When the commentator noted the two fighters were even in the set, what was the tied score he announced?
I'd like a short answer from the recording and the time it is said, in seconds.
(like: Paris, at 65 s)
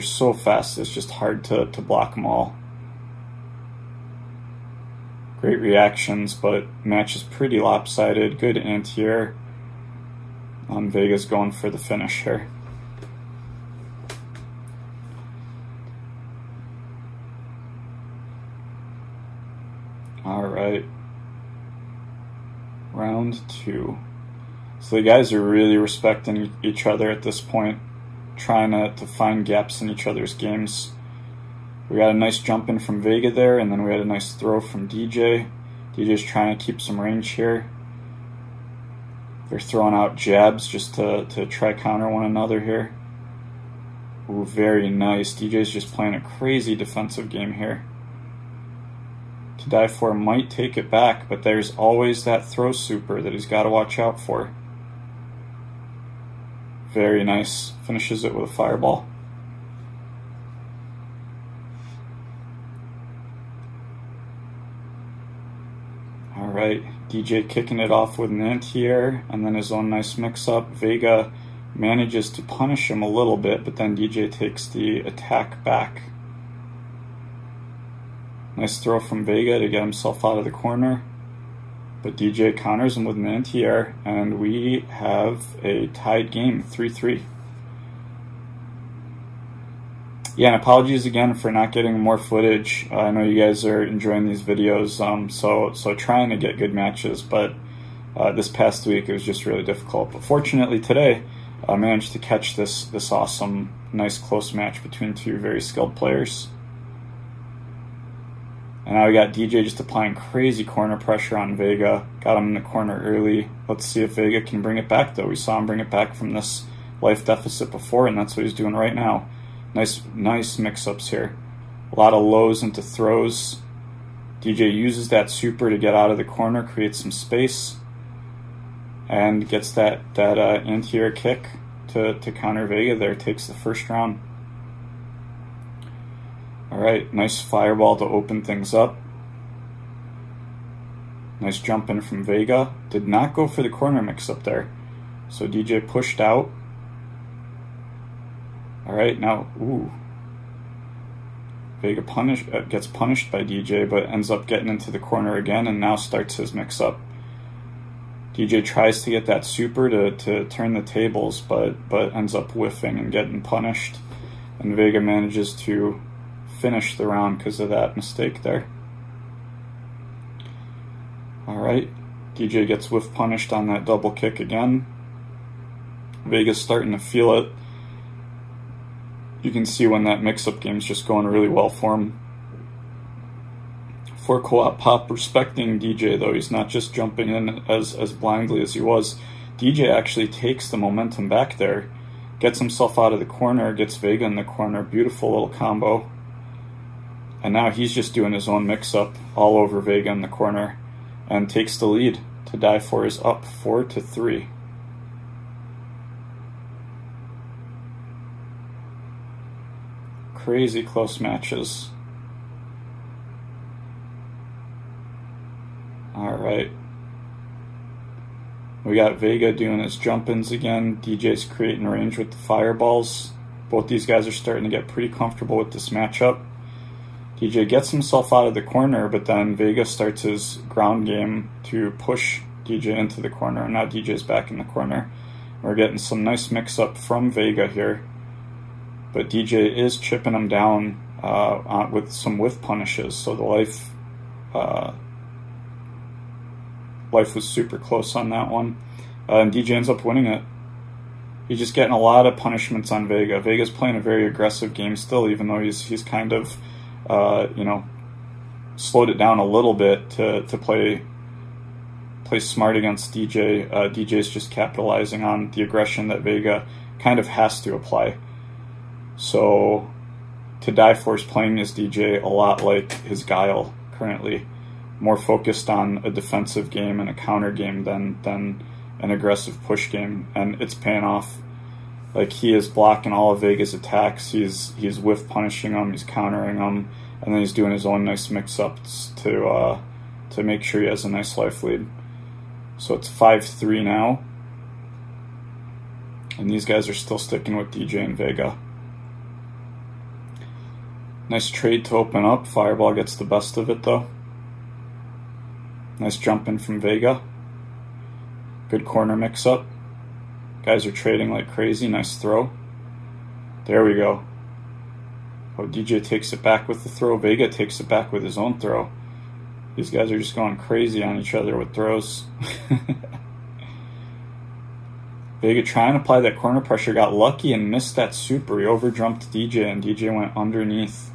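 3-3, at 86 s.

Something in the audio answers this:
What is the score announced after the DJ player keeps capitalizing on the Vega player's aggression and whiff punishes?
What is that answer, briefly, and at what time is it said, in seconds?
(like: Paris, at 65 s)
5-3, at 293 s.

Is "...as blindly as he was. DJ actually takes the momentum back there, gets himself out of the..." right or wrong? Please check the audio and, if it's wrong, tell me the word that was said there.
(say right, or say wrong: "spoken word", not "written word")
right.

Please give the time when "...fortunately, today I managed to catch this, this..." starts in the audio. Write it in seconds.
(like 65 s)
100 s.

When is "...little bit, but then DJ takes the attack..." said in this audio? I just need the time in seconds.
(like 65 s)
73 s.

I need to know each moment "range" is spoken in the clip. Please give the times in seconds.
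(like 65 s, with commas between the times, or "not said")
36 s, 221 s.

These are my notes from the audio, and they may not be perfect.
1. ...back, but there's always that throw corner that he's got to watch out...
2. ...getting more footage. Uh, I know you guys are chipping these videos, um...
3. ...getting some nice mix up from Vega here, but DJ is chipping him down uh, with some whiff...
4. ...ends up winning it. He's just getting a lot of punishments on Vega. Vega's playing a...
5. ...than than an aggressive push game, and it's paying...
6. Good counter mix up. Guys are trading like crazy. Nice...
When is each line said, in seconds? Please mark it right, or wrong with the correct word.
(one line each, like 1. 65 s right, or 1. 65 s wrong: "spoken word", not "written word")
1. 50 s wrong: "super", not "corner"
2. 91 s wrong: "enjoying", not "chipping"
3. 235 s right
4. 249 s right
5. 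277 s right
6. 308 s wrong: "corner", not "counter".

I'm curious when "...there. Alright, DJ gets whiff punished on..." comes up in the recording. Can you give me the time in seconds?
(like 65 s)
168 s.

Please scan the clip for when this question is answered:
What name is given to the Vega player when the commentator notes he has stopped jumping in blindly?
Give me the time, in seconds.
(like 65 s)
184 s.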